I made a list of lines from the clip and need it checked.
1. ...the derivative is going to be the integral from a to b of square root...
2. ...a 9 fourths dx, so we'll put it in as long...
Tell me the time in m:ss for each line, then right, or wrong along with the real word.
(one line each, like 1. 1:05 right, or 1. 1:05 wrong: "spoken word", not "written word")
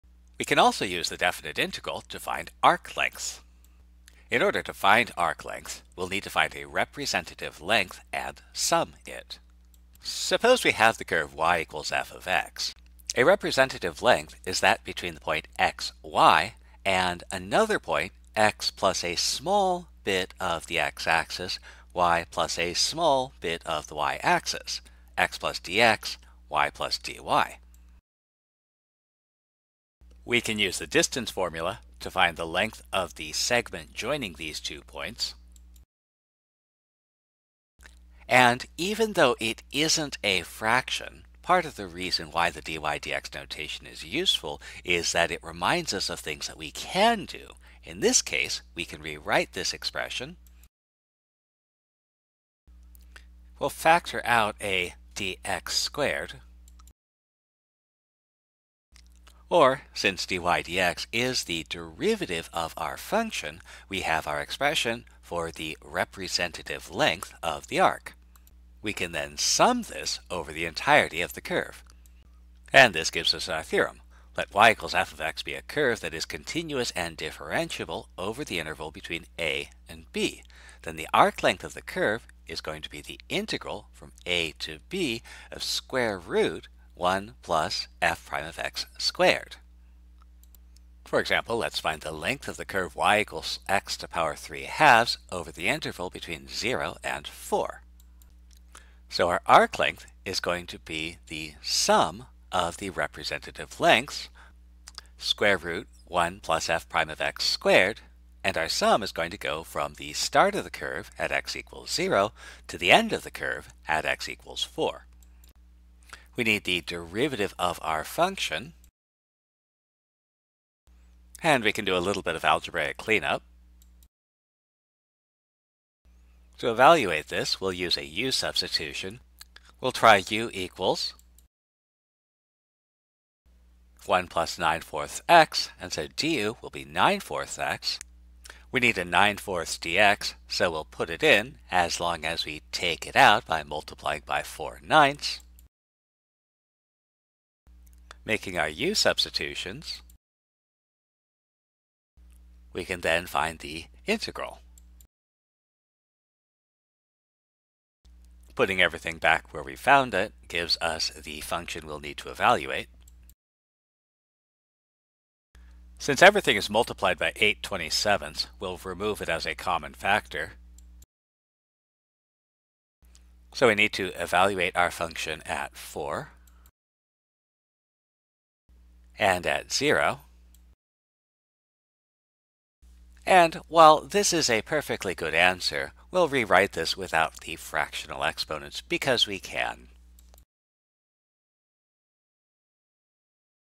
1. 1:21 wrong: "curve", not "derivative"
2. 2:18 right.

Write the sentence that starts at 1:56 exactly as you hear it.
We need the derivative of our function.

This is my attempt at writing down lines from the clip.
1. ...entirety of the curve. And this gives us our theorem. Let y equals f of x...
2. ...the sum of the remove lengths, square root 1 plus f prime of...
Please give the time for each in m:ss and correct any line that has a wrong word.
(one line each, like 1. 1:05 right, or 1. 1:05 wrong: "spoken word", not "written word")
1. 1:10 right
2. 1:41 wrong: "representative", not "remove".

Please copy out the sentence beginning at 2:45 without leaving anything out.
Since everything is multiplied by 8 27 we'll remove it as a common factor.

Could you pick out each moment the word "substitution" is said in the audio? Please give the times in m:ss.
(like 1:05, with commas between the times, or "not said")
2:08, 2:28.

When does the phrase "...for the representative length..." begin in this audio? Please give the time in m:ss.
1:05.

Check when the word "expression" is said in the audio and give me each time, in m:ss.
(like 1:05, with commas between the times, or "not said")
0:49, 1:04.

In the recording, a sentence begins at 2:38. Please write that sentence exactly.
Putting everything back where we found it gives us the function we'll need to evaluate.